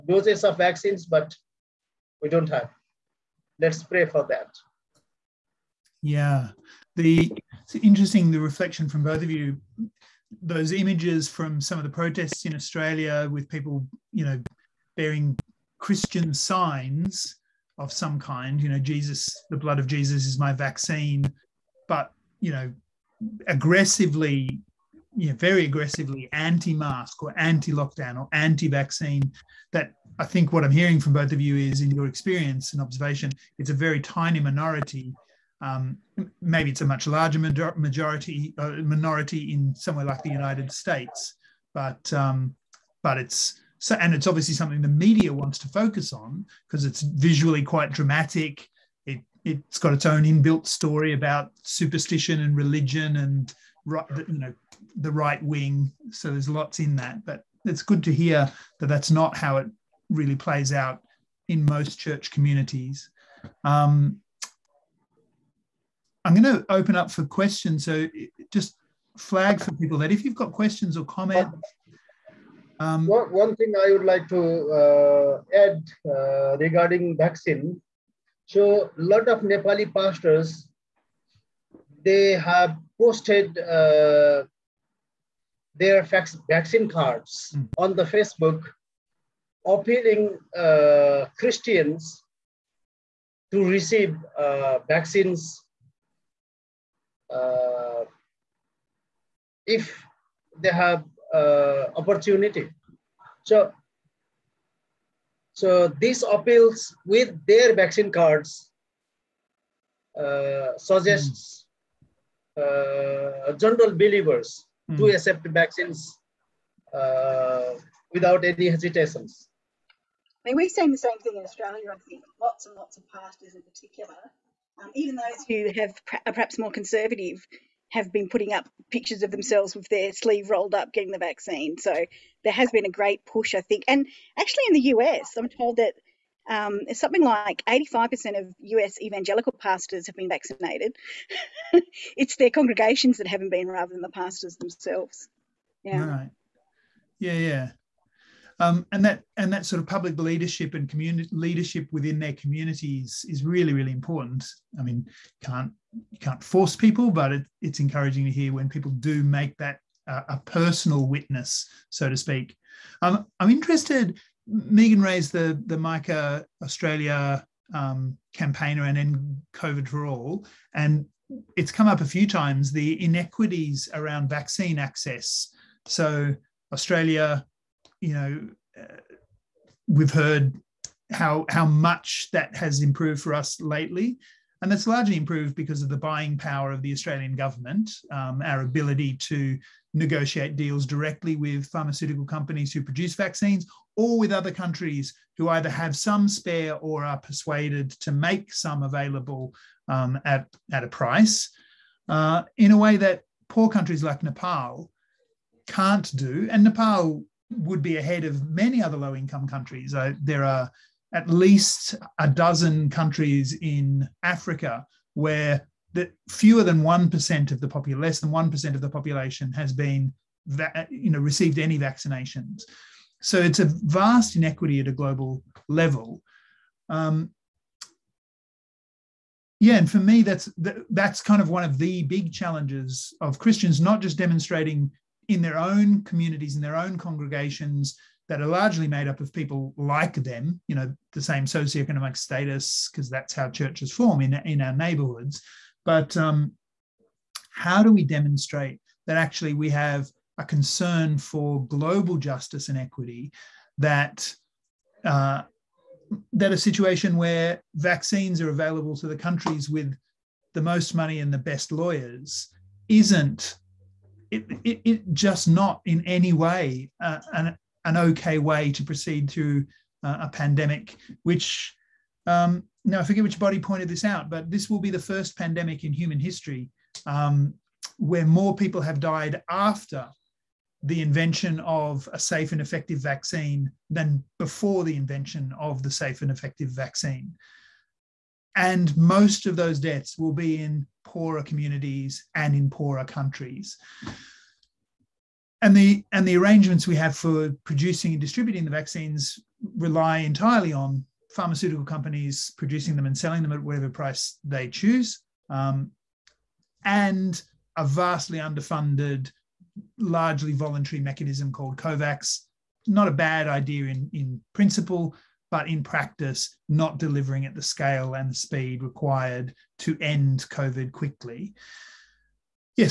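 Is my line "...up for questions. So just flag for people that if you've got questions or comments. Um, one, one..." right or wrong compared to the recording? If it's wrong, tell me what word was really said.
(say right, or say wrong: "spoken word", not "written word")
right.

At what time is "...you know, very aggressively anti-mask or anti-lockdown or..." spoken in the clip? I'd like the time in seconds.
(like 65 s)
25 s.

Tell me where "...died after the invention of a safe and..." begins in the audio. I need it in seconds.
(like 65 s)
278 s.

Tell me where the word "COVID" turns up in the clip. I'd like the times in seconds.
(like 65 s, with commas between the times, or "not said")
169 s, 320 s.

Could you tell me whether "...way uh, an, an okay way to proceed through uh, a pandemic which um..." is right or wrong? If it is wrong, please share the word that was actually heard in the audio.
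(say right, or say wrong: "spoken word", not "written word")
right.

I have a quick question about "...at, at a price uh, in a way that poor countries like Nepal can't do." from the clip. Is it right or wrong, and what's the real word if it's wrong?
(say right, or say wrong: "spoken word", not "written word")
right.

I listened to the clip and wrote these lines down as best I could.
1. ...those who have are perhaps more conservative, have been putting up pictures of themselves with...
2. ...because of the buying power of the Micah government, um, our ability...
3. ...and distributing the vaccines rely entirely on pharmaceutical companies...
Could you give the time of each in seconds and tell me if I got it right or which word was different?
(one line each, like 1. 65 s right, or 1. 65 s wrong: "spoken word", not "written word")
1. 125 s right
2. 185 s wrong: "Australian", not "Micah"
3. 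298 s right.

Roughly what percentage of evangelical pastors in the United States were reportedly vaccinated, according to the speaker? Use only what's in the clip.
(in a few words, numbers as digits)
85%.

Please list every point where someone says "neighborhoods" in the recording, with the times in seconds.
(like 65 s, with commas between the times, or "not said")
244 s.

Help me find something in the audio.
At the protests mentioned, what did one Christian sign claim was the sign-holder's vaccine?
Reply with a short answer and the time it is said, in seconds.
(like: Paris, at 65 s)
The blood of Jesus, at 19 s.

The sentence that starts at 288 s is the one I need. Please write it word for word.
And most of those deaths will be in poorer communities and in poorer countries.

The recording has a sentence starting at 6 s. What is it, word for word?
Yeah, the it's interesting the reflection from both of you.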